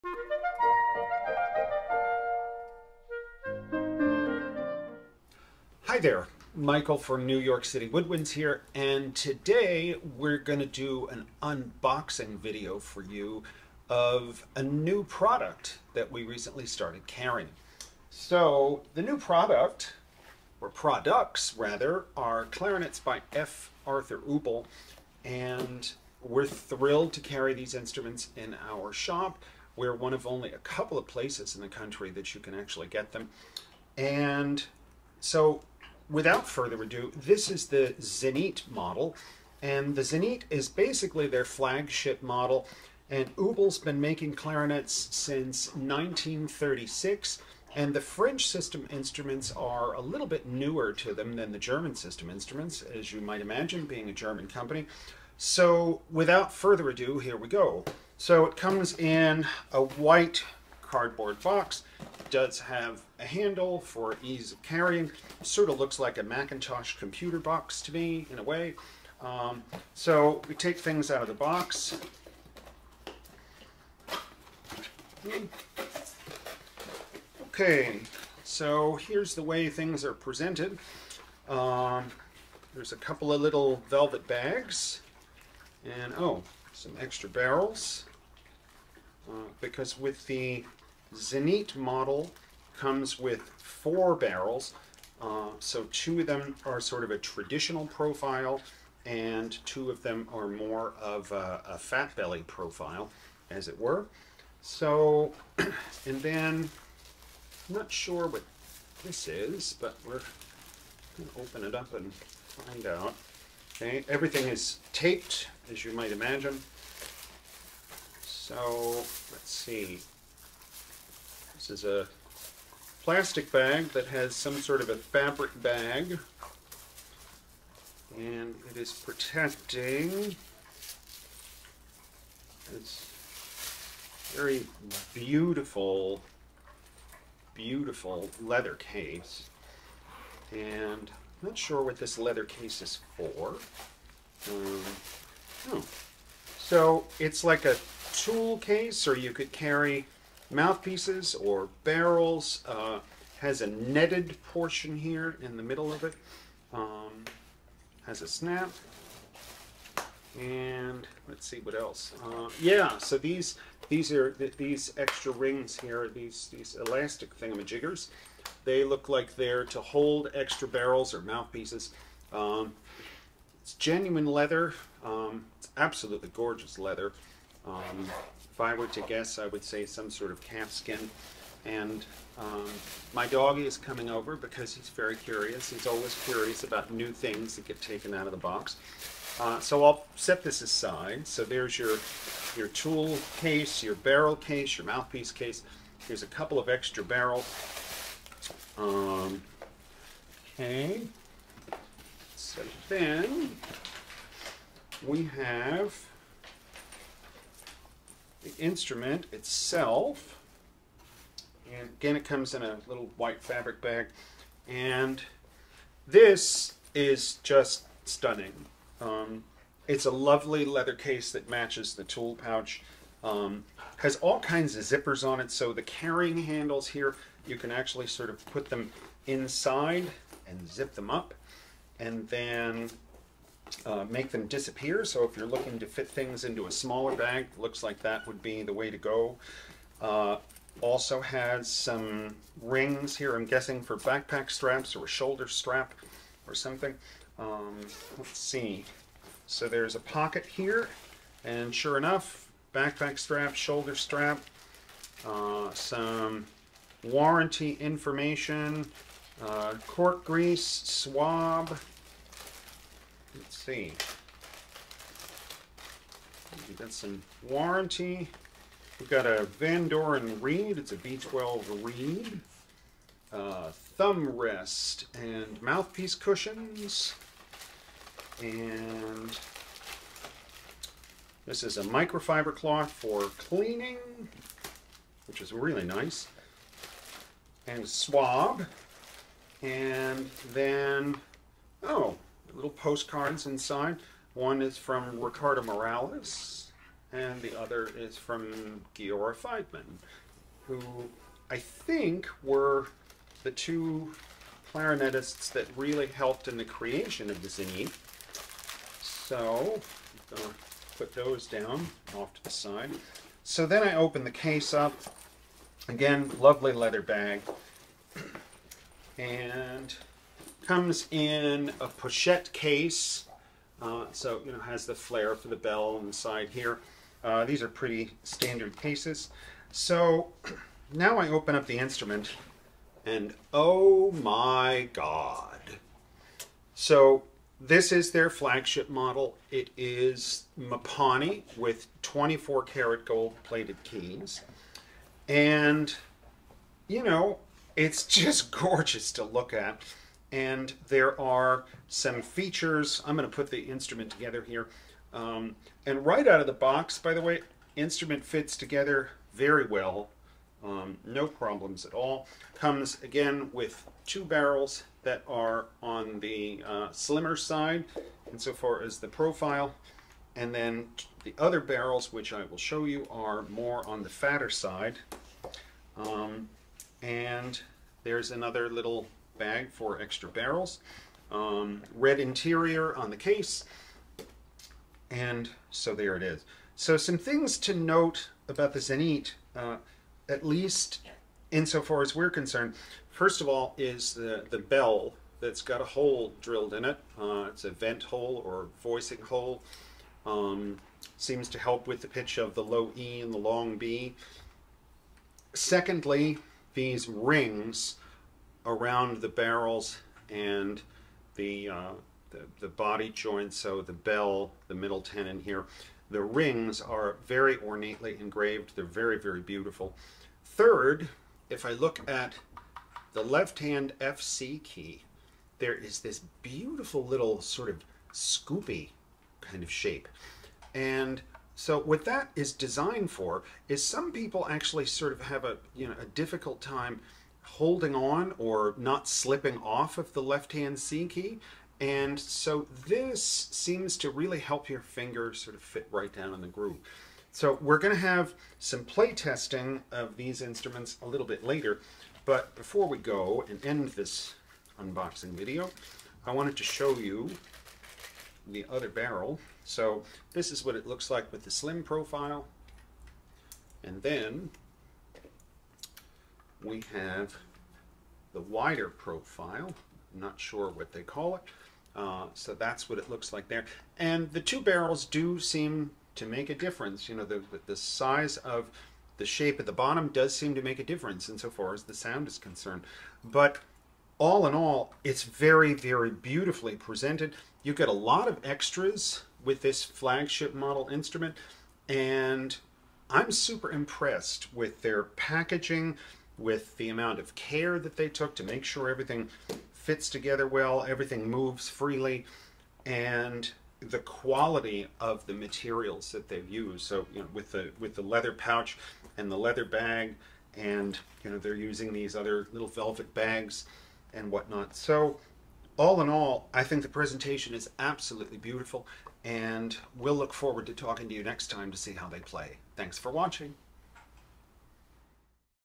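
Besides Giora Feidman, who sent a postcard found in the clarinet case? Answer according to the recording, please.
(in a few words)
Ricardo Morales.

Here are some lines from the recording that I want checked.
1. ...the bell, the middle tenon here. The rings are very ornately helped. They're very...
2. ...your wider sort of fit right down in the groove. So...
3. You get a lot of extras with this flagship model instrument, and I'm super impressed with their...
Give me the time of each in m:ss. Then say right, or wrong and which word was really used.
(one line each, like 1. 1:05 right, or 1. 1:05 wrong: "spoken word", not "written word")
1. 6:53 wrong: "engraved", not "helped"
2. 7:24 wrong: "finger", not "wider"
3. 8:07 right.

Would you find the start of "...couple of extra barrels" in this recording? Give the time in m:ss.
3:16.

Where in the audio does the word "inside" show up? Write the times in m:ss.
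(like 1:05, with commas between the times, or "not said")
3:49, 4:53.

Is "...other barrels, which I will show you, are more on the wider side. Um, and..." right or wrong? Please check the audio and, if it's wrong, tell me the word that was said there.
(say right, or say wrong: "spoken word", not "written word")
wrong: "fatter", not "wider".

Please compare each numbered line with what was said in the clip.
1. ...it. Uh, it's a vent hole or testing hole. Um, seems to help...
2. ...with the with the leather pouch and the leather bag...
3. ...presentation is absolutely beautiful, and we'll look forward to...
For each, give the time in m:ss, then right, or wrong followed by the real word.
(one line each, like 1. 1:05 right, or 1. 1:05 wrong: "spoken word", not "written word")
1. 6:36 wrong: "voicing", not "testing"
2. 8:27 right
3. 8:36 right.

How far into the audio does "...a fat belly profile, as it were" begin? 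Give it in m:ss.
1:41.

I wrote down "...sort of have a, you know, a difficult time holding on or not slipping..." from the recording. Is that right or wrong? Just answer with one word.
right.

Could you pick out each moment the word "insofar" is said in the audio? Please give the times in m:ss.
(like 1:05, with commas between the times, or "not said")
6:08, 6:31, 8:01.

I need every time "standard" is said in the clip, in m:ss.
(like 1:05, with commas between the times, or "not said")
5:28.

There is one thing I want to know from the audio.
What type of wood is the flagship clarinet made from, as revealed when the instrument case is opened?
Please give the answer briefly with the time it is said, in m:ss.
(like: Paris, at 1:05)
Mapani, at 5:40.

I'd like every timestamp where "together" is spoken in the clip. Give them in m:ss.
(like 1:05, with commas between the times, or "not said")
5:54, 5:58, 8:20.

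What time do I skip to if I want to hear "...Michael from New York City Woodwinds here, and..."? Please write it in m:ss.
0:06.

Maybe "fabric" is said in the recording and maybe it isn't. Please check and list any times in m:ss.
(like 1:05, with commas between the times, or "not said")
2:04, 3:33.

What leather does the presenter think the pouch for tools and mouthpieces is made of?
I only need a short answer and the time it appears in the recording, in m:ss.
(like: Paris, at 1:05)
Calfskin, at 3:00.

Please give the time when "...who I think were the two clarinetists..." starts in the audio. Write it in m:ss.
5:00.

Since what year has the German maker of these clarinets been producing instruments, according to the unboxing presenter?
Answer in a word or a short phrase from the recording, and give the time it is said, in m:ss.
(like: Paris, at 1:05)
1936, at 0:45.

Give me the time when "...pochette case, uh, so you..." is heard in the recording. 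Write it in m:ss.
5:21.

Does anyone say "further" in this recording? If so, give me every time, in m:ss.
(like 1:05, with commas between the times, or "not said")
0:36, 0:56.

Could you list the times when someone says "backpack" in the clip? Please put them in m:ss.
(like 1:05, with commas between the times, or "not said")
4:03, 4:12.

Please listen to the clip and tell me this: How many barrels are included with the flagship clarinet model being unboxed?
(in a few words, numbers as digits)
4.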